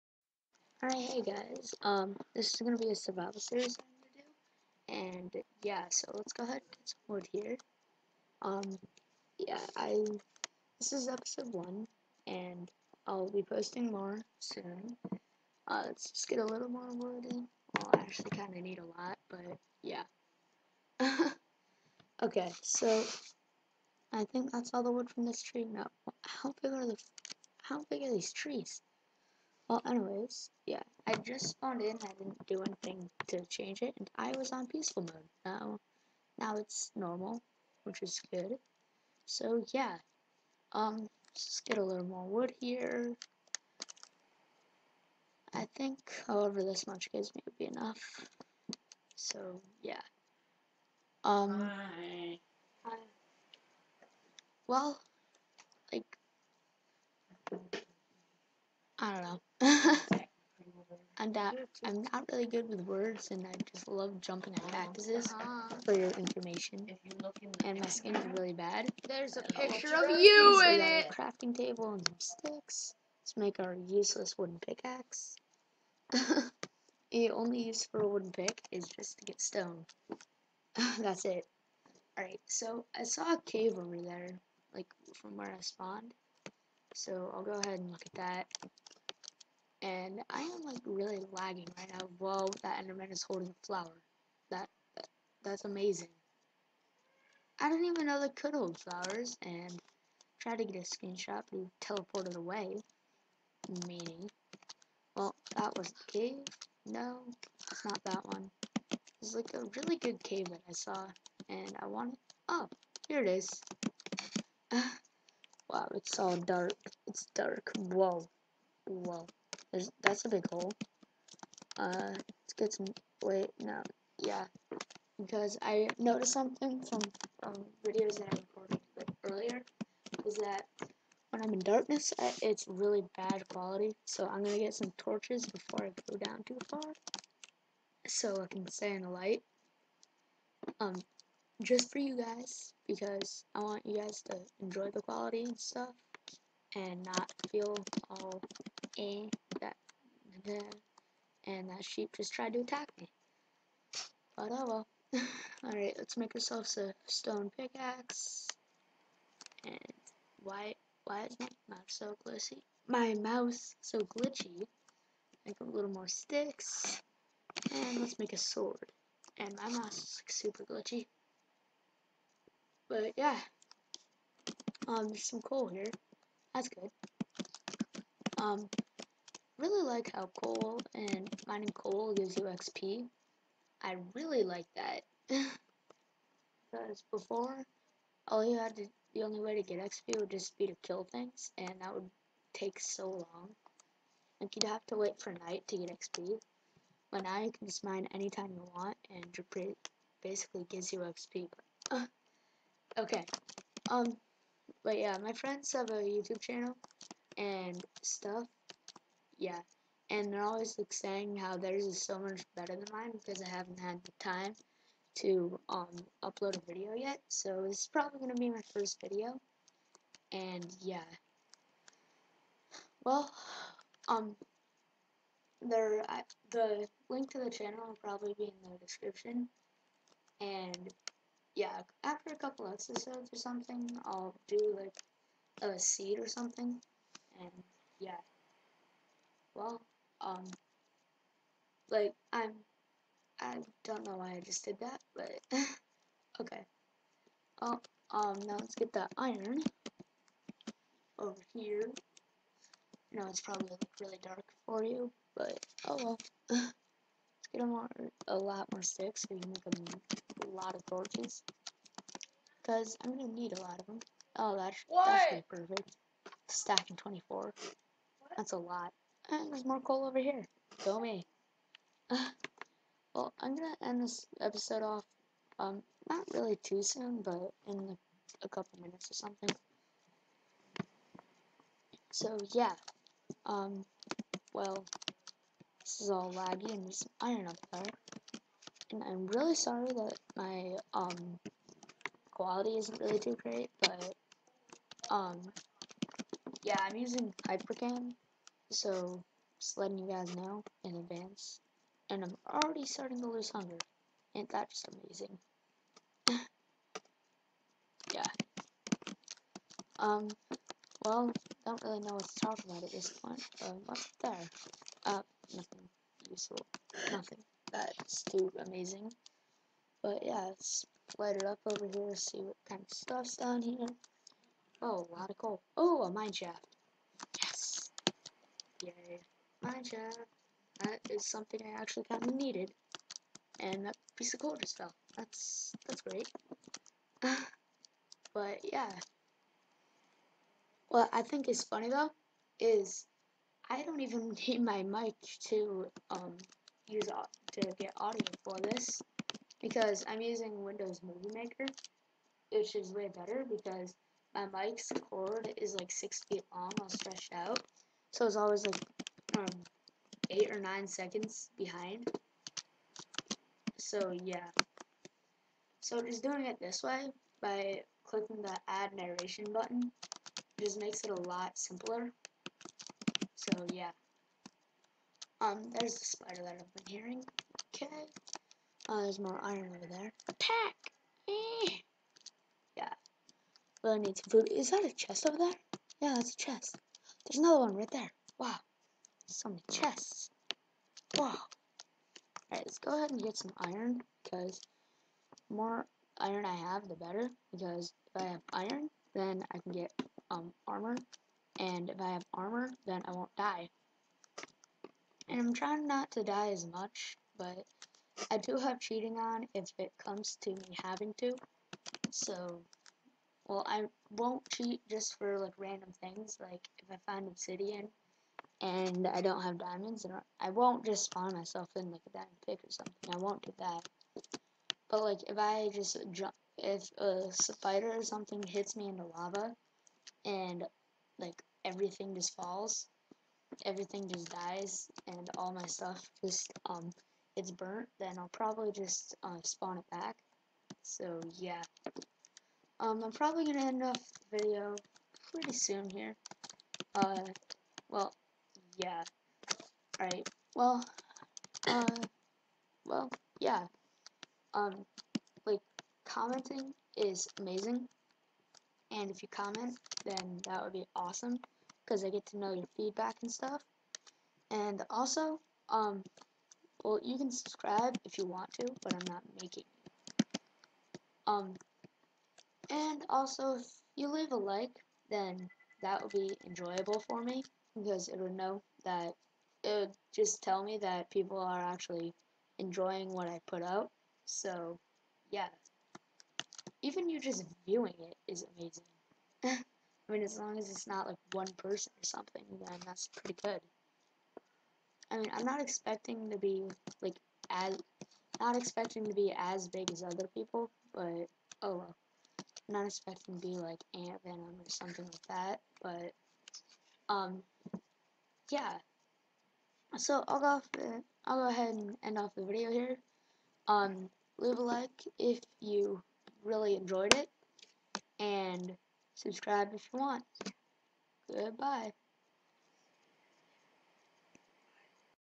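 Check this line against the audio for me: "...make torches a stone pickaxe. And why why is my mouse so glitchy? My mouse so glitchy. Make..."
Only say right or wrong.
wrong.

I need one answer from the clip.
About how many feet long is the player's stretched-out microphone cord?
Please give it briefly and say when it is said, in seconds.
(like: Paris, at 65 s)
6, at 355 s.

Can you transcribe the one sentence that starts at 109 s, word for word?
It's like a really good cave that I saw, and I wanted.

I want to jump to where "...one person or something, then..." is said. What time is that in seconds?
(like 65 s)
491 s.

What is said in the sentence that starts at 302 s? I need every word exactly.
And I'm already starting to lose hunger.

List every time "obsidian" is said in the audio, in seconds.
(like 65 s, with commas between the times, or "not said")
417 s.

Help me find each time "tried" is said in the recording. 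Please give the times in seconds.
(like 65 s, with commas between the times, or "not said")
100 s, 152 s.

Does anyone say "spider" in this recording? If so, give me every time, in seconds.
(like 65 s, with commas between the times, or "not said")
376 s, 427 s.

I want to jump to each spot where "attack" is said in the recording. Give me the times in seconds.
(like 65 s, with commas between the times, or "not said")
152 s, 380 s.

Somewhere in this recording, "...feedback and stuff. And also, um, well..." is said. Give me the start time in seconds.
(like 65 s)
462 s.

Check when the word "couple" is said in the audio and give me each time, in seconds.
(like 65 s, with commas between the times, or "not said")
232 s, 278 s.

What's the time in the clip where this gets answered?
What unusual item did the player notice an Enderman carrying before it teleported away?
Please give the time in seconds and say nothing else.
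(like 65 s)
93 s.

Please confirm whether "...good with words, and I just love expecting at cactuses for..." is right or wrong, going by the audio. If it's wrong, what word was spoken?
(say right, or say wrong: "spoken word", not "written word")
wrong: "jumping", not "expecting".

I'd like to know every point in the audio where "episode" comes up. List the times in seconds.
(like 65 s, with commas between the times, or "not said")
11 s, 232 s, 274 s.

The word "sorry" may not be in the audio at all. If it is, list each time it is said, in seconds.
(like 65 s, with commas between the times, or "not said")
289 s.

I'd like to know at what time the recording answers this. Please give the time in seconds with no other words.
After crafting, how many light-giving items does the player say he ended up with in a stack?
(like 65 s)
266 s.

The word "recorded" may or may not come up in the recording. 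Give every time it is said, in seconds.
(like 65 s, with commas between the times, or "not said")
128 s.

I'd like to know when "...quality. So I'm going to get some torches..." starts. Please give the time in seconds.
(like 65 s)
133 s.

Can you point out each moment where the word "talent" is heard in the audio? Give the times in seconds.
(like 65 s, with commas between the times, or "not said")
not said.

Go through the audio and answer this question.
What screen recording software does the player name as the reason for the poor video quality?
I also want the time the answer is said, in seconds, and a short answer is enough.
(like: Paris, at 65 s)
Hypercam, at 297 s.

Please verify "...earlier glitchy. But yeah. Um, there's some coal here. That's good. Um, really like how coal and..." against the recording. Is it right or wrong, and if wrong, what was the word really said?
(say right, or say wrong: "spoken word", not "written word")
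wrong: "super", not "earlier".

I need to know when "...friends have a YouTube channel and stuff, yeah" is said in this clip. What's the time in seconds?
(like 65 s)
205 s.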